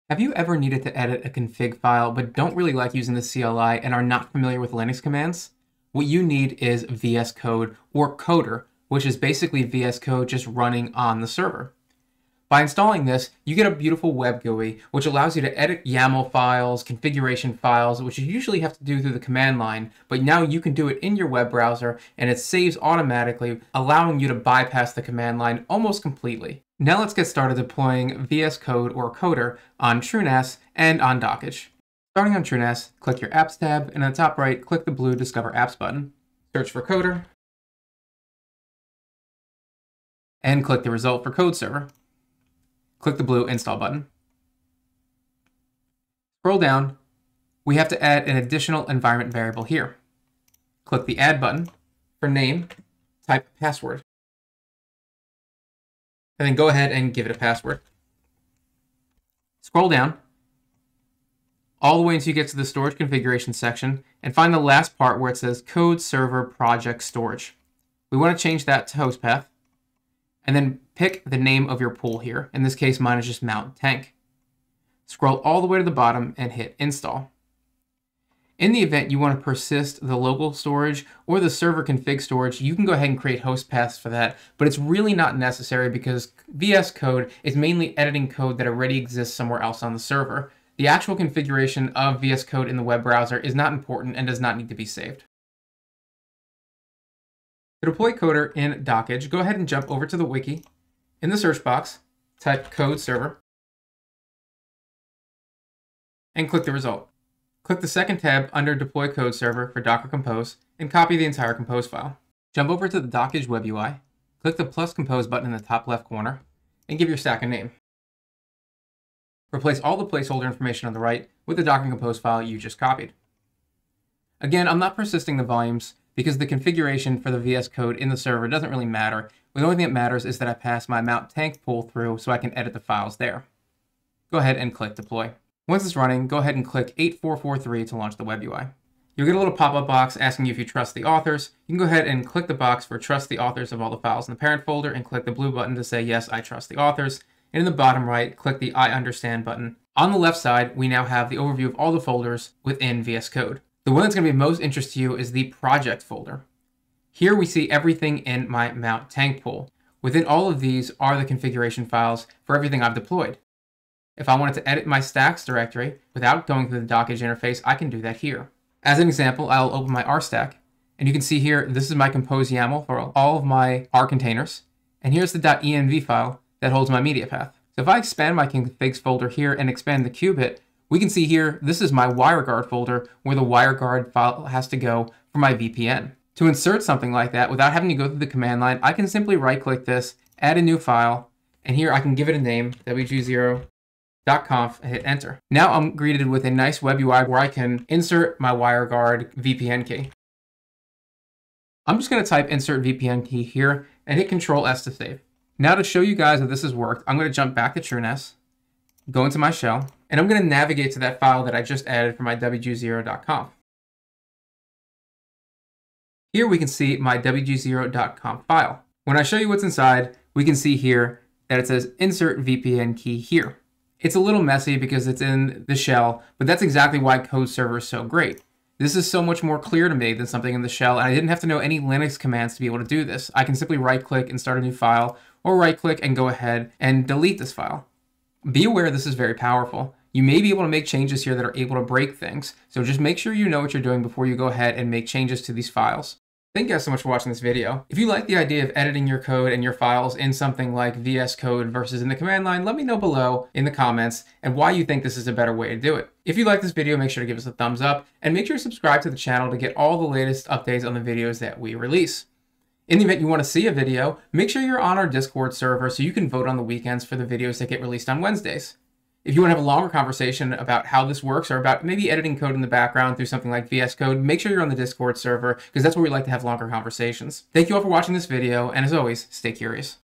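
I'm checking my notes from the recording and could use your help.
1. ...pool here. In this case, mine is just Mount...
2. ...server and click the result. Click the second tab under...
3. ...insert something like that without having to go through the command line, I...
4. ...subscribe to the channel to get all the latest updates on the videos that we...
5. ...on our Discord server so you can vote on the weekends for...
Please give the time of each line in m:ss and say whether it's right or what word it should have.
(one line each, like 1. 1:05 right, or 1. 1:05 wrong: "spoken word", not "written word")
1. 1:11 right
2. 1:42 right
3. 3:06 right
4. 4:18 right
5. 4:24 right.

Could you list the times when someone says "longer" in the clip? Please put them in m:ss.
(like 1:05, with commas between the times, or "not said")
4:29, 4:36.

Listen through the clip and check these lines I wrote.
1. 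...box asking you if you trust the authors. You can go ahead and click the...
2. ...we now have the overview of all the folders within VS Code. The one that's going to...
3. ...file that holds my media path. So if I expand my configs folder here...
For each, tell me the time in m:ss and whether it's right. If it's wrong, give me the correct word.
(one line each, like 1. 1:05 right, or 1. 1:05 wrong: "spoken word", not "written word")
1. 2:19 right
2. 2:30 right
3. 2:56 right.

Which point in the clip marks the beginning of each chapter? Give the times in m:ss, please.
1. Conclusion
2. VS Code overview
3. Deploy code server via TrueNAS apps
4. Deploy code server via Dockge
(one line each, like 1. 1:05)
1. 4:06
2. 2:19
3. 0:33
4. 1:38.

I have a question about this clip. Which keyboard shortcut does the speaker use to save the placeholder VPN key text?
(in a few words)
Control S.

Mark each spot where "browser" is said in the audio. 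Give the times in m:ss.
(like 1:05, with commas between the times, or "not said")
0:21, 1:33.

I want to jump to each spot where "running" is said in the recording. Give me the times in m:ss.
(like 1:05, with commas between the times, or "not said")
0:10, 2:15.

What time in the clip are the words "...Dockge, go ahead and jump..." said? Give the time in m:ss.
1:38.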